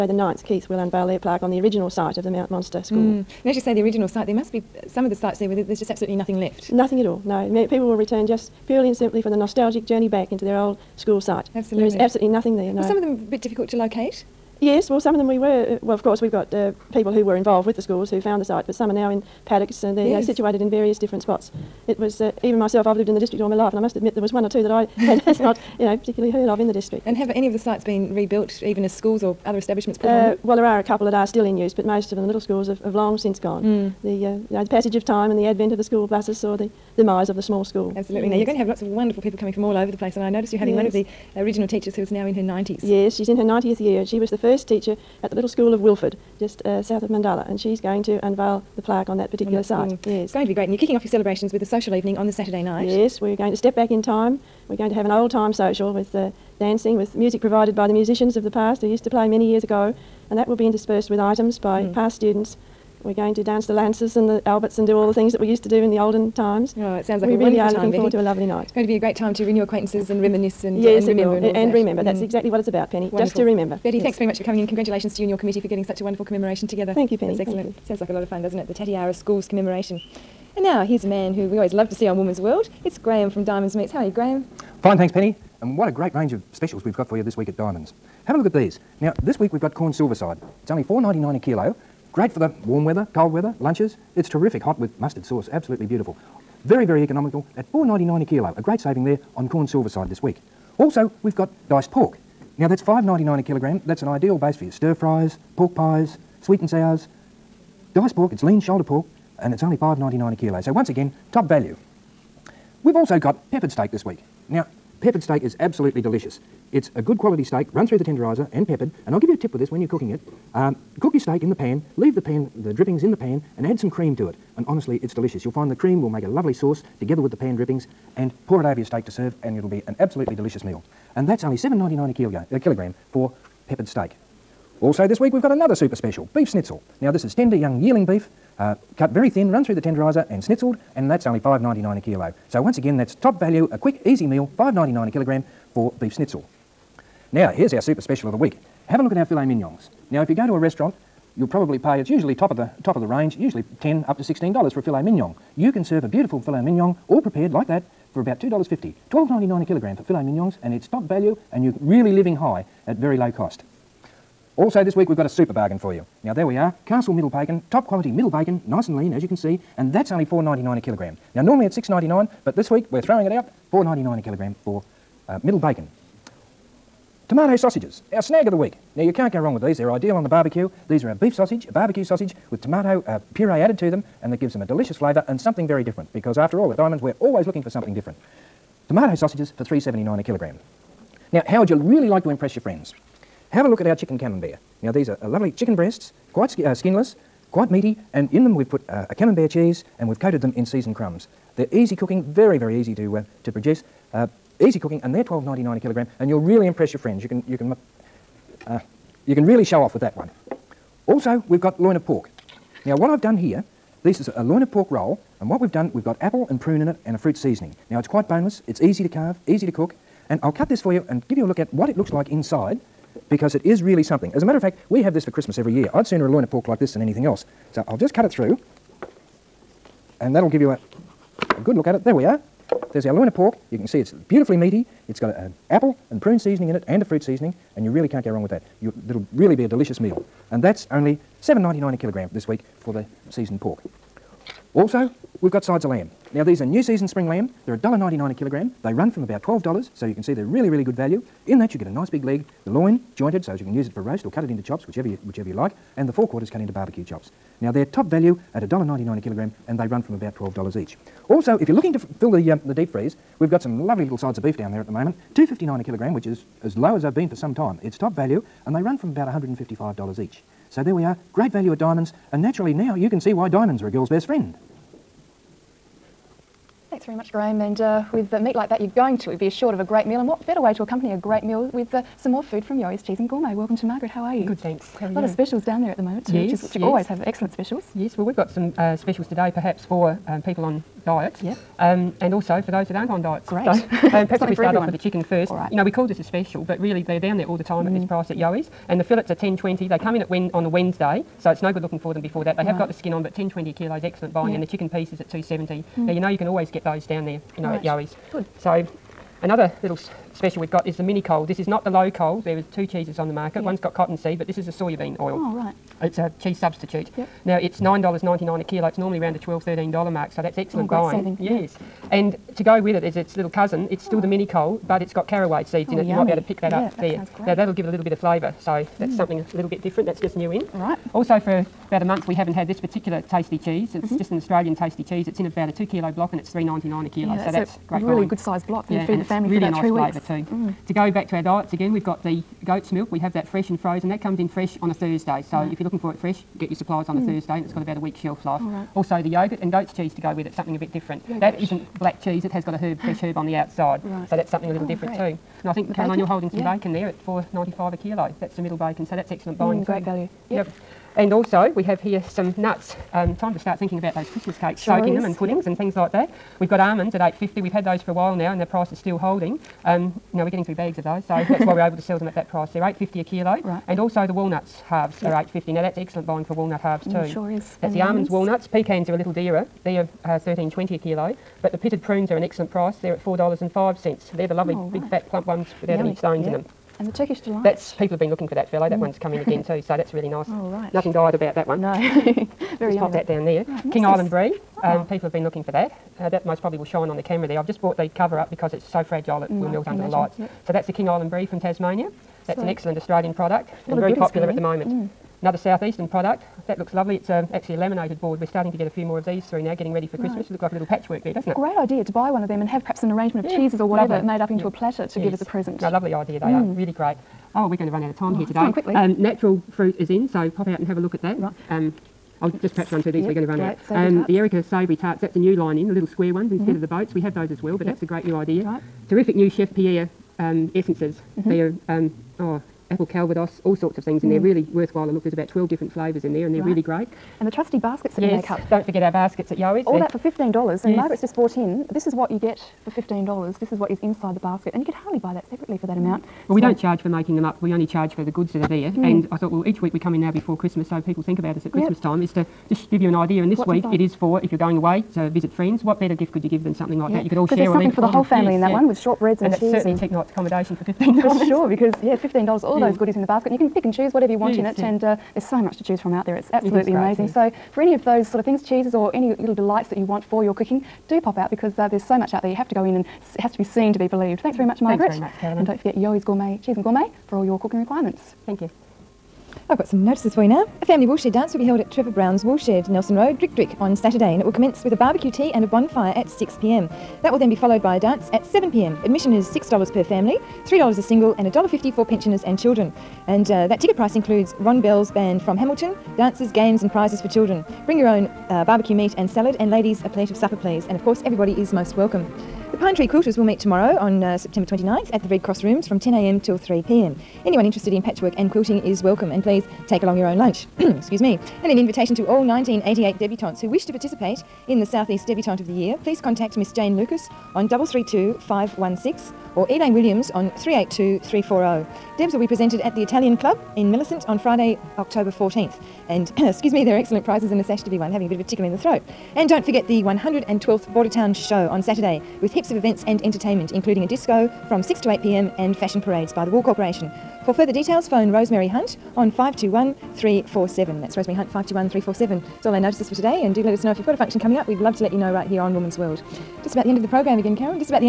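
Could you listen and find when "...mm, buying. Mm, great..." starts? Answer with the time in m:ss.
5:59.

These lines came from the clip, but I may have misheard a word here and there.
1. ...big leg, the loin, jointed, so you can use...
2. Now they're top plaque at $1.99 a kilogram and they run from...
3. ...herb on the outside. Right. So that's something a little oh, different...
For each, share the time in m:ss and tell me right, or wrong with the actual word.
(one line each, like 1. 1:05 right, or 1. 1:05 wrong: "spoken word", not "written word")
1. 4:12 right
2. 4:17 wrong: "value", not "plaque"
3. 5:53 right.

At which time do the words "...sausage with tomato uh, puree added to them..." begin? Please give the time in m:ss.
3:02.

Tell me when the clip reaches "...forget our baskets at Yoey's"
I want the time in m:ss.
7:18.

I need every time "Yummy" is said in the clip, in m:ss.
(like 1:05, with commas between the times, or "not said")
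5:26, 6:25.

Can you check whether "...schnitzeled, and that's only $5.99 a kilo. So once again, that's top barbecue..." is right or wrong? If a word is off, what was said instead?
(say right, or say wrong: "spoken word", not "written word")
wrong: "value", not "barbecue".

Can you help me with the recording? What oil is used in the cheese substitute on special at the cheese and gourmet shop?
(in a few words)
soya bean oil.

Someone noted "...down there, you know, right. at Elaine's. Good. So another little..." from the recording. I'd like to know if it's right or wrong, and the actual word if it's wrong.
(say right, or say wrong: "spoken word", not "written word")
wrong: "Yoey", not "Elaine".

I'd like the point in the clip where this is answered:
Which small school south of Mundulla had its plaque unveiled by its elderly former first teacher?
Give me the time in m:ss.
0:45.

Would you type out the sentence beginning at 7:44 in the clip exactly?
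And uh, there's so much to choose from out there.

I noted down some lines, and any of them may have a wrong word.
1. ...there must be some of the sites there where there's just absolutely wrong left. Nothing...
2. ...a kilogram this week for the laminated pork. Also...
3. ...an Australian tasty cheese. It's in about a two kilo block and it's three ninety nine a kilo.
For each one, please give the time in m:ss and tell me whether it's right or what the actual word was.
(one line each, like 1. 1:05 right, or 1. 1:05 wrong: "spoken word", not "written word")
1. 0:04 wrong: "nothing", not "wrong"
2. 4:01 wrong: "seasoned", not "laminated"
3. 5:34 right.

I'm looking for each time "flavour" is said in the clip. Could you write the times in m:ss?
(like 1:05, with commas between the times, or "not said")
3:04, 5:28, 7:15.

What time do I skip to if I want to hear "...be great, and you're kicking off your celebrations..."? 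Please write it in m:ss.
0:50.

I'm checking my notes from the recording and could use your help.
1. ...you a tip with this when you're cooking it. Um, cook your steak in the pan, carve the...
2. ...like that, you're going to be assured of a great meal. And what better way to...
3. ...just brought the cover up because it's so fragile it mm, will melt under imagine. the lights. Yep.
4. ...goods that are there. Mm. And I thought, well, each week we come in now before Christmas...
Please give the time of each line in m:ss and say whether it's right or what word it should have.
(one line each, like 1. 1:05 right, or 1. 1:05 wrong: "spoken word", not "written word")
1. 1:59 wrong: "leave", not "carve"
2. 4:38 right
3. 6:37 right
4. 7:28 right.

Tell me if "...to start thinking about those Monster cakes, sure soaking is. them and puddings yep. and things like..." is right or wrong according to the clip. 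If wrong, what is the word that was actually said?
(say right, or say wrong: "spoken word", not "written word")
wrong: "Christmas", not "Monster".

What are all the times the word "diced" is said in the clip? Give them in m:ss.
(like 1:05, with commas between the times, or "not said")
1:41, 1:47.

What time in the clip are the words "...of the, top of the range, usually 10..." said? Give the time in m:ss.
2:32.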